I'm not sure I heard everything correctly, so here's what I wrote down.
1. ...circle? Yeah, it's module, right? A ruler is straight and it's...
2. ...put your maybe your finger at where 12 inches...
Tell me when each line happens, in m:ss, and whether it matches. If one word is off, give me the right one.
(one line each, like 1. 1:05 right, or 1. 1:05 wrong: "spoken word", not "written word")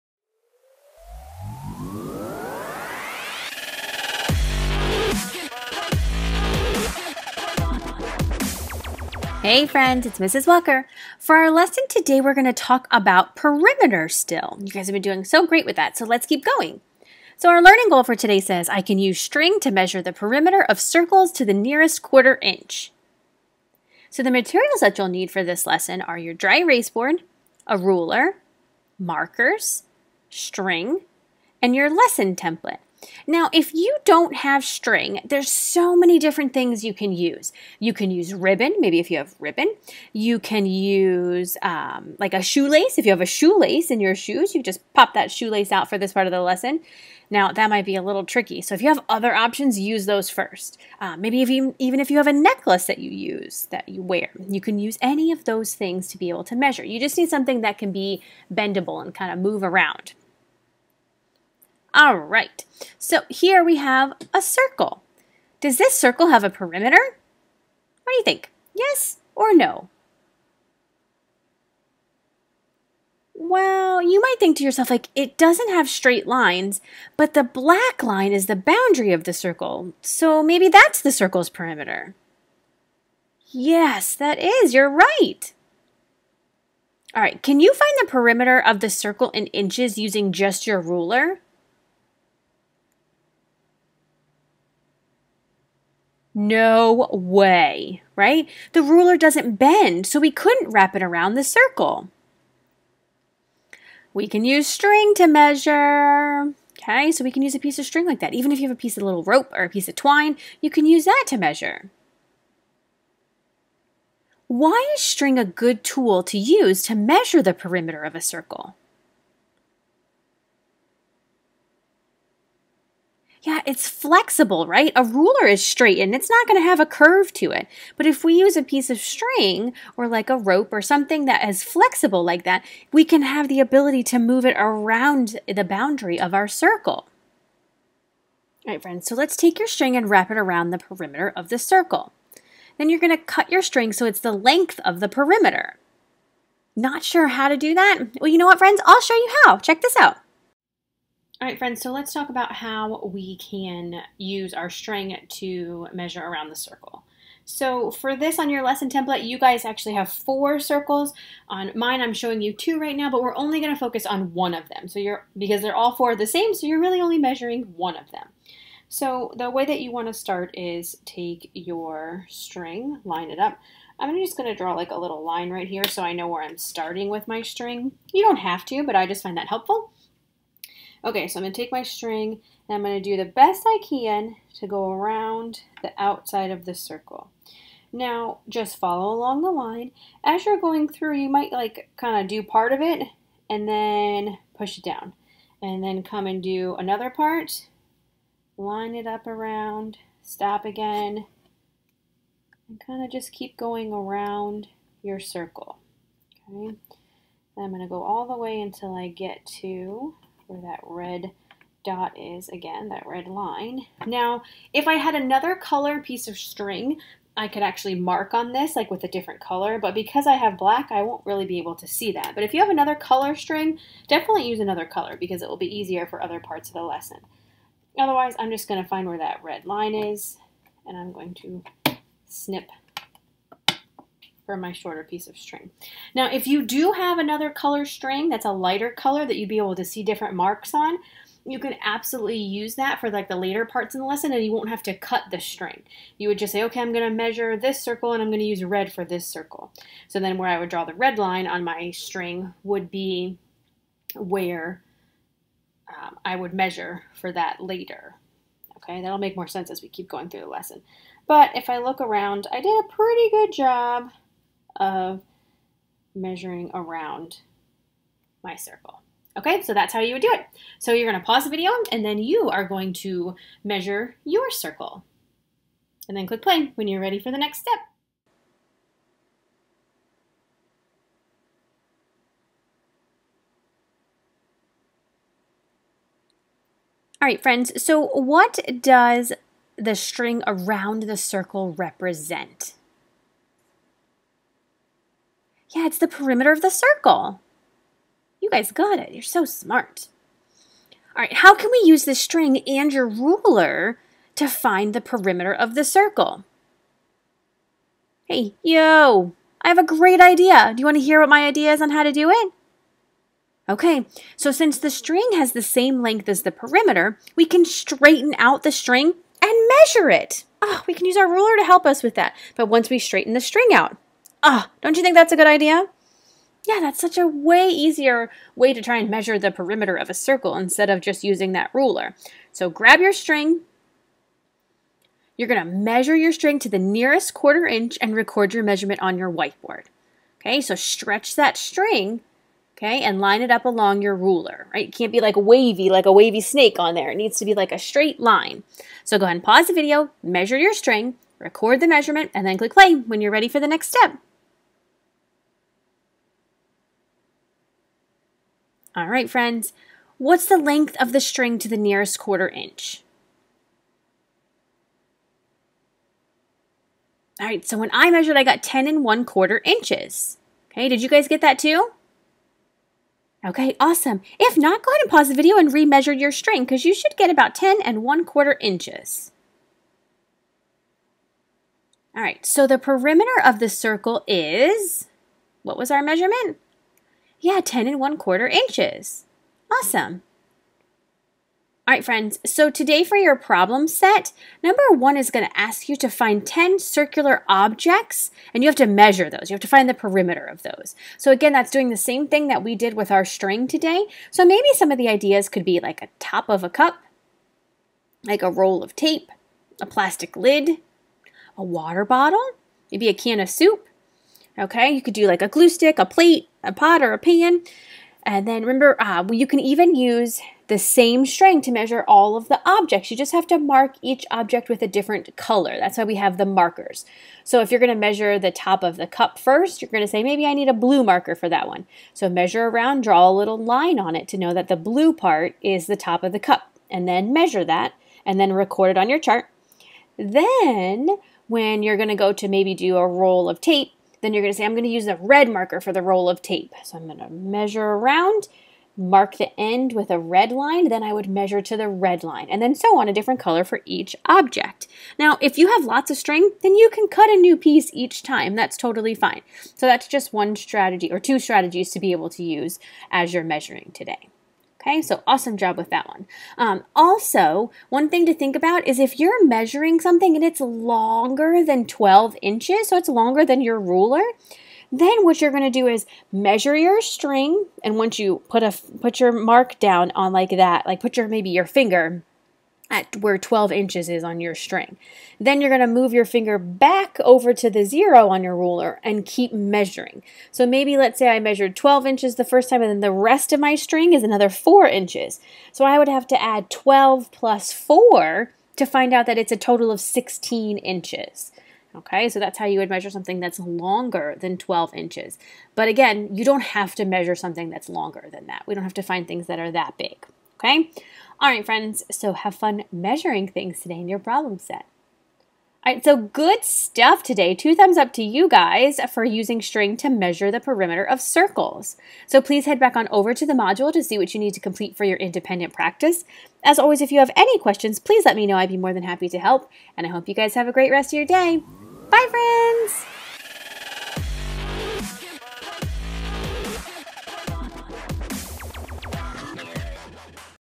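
1. 1:58 wrong: "flexible", not "module"
2. 8:00 right.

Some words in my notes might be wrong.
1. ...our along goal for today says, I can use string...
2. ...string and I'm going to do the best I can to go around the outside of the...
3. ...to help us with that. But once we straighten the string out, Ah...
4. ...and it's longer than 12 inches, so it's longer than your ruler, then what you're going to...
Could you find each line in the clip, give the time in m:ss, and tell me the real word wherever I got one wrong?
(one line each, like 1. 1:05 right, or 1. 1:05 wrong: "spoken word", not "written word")
1. 0:17 wrong: "learning", not "along"
2. 3:01 right
3. 5:21 right
4. 7:50 right.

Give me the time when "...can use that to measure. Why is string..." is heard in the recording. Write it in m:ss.
1:50.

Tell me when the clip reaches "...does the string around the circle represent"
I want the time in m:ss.
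4:48.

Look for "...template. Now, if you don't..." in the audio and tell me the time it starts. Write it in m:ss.
0:32.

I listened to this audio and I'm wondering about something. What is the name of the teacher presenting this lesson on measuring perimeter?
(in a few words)
Mrs. Walker.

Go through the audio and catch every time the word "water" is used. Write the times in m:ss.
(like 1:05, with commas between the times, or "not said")
6:51.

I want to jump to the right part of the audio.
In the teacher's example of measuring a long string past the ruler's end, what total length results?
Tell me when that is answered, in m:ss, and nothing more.
8:20.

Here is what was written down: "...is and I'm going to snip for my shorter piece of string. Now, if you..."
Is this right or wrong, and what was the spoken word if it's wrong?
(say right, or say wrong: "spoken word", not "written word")
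right.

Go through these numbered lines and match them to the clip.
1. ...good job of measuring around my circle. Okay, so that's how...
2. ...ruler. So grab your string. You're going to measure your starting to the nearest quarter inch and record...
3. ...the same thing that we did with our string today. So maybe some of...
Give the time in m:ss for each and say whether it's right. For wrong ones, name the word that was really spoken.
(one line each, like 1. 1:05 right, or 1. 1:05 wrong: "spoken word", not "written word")
1. 4:23 right
2. 5:31 wrong: "string", not "starting"
3. 6:41 right.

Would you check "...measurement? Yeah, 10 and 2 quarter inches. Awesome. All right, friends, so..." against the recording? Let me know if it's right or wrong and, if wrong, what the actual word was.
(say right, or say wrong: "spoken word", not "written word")
wrong: "1", not "2".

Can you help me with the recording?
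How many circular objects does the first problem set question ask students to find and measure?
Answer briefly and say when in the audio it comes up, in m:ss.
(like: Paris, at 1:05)
10, at 6:36.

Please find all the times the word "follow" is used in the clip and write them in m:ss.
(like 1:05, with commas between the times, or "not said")
3:08.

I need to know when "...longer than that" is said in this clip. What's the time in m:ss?
8:27.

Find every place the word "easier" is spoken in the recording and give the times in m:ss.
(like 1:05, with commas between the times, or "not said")
3:45, 5:27.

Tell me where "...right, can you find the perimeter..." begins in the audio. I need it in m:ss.
1:27.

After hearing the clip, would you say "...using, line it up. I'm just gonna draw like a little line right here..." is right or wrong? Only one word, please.
wrong.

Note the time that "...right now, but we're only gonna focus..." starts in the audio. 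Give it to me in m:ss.
2:42.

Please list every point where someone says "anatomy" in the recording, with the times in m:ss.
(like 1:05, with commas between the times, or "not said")
not said.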